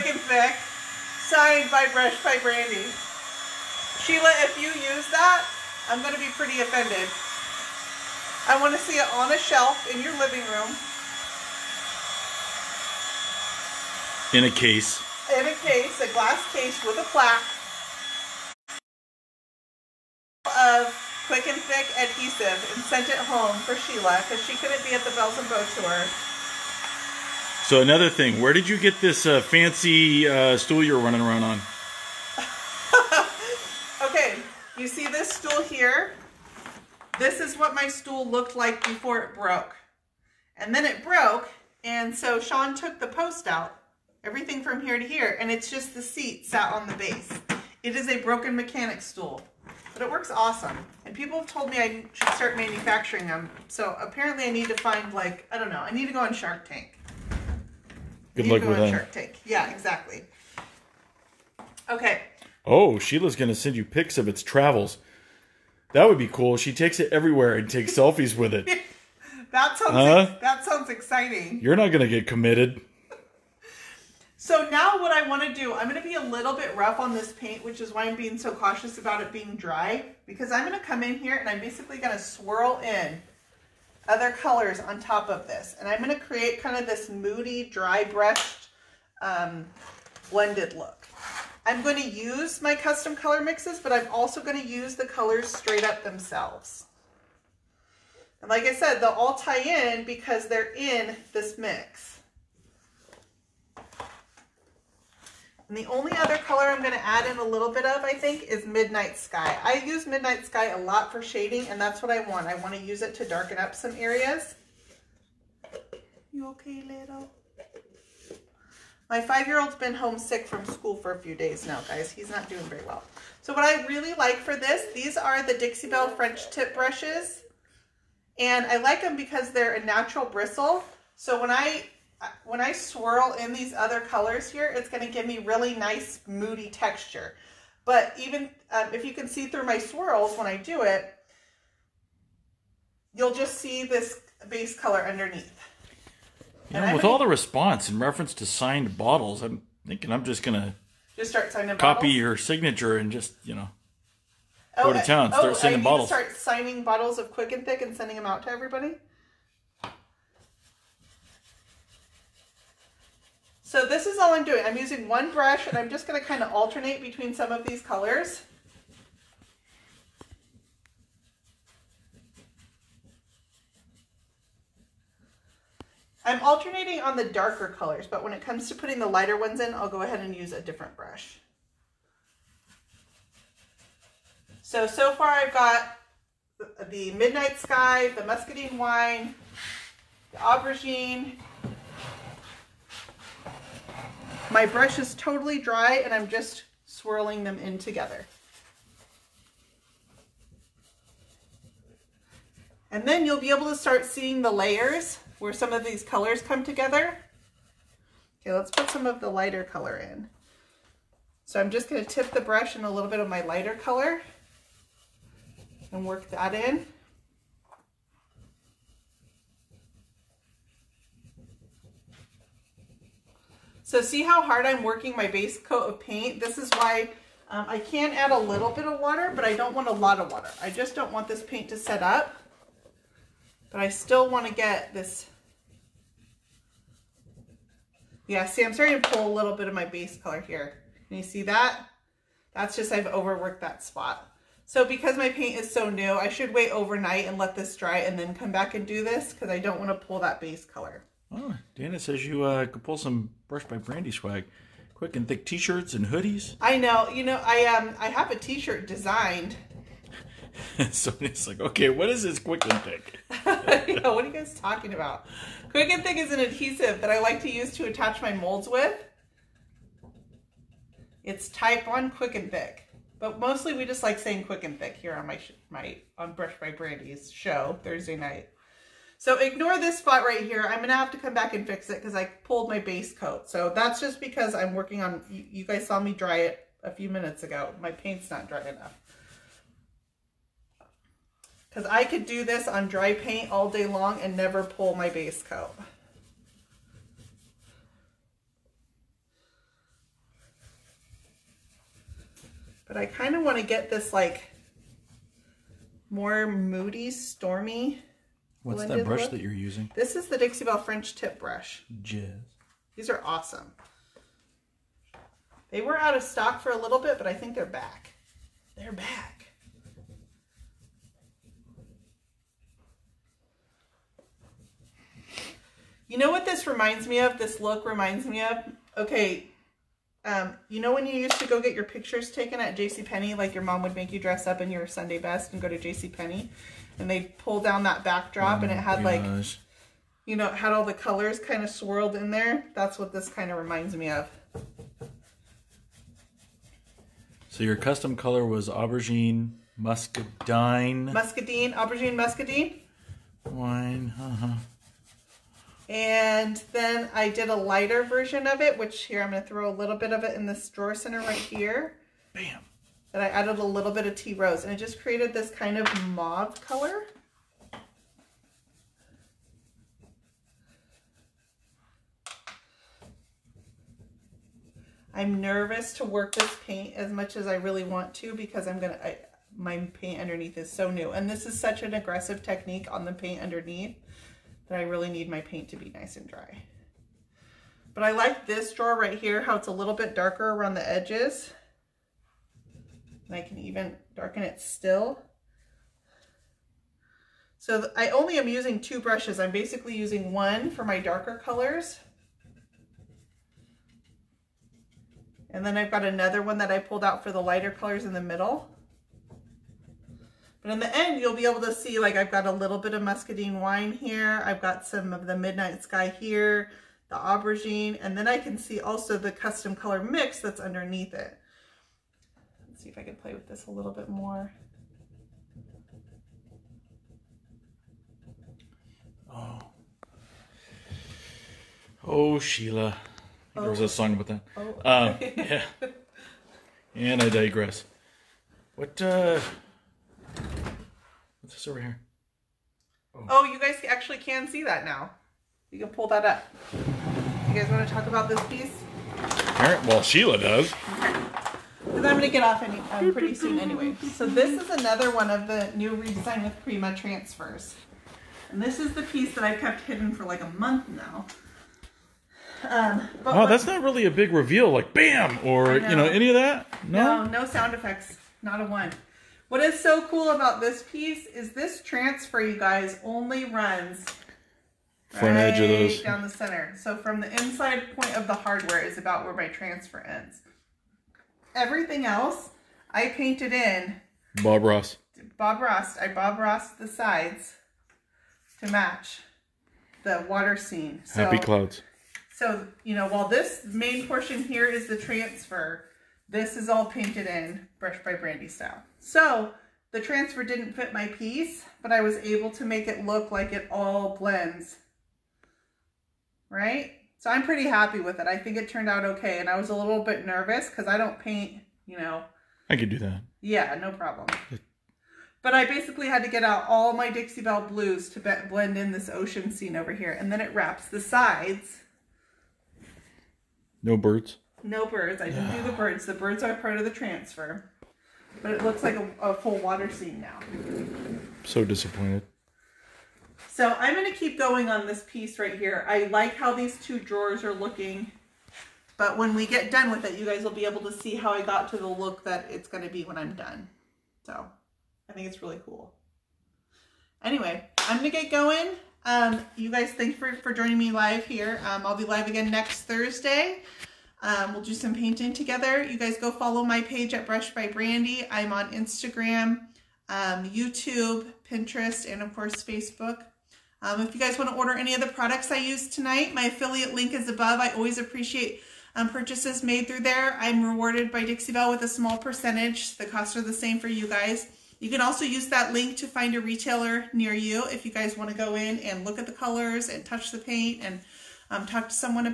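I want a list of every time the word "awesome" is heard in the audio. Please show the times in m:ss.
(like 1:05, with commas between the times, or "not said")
0:50, 5:13.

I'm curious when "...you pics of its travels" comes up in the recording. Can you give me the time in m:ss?
1:03.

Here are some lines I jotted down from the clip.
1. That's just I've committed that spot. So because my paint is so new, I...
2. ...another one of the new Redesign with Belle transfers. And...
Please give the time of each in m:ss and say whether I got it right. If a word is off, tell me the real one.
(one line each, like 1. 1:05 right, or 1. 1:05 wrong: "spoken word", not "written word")
1. 4:02 wrong: "overworked", not "committed"
2. 7:34 wrong: "Prima", not "Belle".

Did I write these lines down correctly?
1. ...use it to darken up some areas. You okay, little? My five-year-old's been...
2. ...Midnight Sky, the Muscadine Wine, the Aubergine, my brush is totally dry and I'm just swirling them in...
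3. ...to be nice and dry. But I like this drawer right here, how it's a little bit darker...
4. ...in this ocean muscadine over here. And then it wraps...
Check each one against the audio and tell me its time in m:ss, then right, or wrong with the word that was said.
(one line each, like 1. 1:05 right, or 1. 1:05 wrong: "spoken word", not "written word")
1. 1:52 right
2. 3:07 right
3. 6:25 right
4. 8:38 wrong: "scene", not "muscadine".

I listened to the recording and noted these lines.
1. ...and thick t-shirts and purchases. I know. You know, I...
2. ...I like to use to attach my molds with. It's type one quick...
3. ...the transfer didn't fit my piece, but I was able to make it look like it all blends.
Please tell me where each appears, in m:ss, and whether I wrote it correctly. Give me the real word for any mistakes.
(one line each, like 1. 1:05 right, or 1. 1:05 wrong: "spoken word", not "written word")
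1. 4:15 wrong: "hoodies", not "purchases"
2. 4:27 right
3. 8:19 right.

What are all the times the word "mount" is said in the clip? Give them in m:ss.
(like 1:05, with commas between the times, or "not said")
not said.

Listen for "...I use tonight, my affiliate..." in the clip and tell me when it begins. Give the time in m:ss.
9:25.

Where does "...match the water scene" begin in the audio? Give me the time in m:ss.
8:08.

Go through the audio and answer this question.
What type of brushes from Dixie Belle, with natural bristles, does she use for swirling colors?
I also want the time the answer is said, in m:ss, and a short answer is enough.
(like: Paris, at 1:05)
French tip brushes, at 2:06.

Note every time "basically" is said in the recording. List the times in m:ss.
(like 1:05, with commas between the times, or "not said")
1:21, 6:39, 8:35.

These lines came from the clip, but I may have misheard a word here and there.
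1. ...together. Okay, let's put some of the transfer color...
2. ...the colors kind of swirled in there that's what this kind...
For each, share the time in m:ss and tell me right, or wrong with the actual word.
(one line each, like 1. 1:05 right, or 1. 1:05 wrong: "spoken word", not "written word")
1. 3:26 wrong: "lighter", not "transfer"
2. 5:40 right.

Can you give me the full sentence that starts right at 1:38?
And like I said, they'll all tie in because they're in this mix.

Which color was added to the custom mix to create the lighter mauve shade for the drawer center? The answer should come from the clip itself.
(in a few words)
tea rose.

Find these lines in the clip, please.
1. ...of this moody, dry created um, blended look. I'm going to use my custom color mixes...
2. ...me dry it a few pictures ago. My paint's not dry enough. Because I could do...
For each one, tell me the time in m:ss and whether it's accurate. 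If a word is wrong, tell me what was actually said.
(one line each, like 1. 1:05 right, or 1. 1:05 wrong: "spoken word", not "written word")
1. 1:26 wrong: "brushed", not "created"
2. 4:46 wrong: "minutes", not "pictures".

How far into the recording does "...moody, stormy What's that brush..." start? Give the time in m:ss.
5:06.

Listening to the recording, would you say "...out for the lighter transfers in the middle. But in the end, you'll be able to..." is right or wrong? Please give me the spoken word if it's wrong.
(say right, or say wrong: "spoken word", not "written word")
wrong: "colors", not "transfers".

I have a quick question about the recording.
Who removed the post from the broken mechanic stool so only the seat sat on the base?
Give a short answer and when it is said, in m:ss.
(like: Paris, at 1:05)
Sean, at 0:42.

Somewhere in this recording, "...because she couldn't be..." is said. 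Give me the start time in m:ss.
0:24.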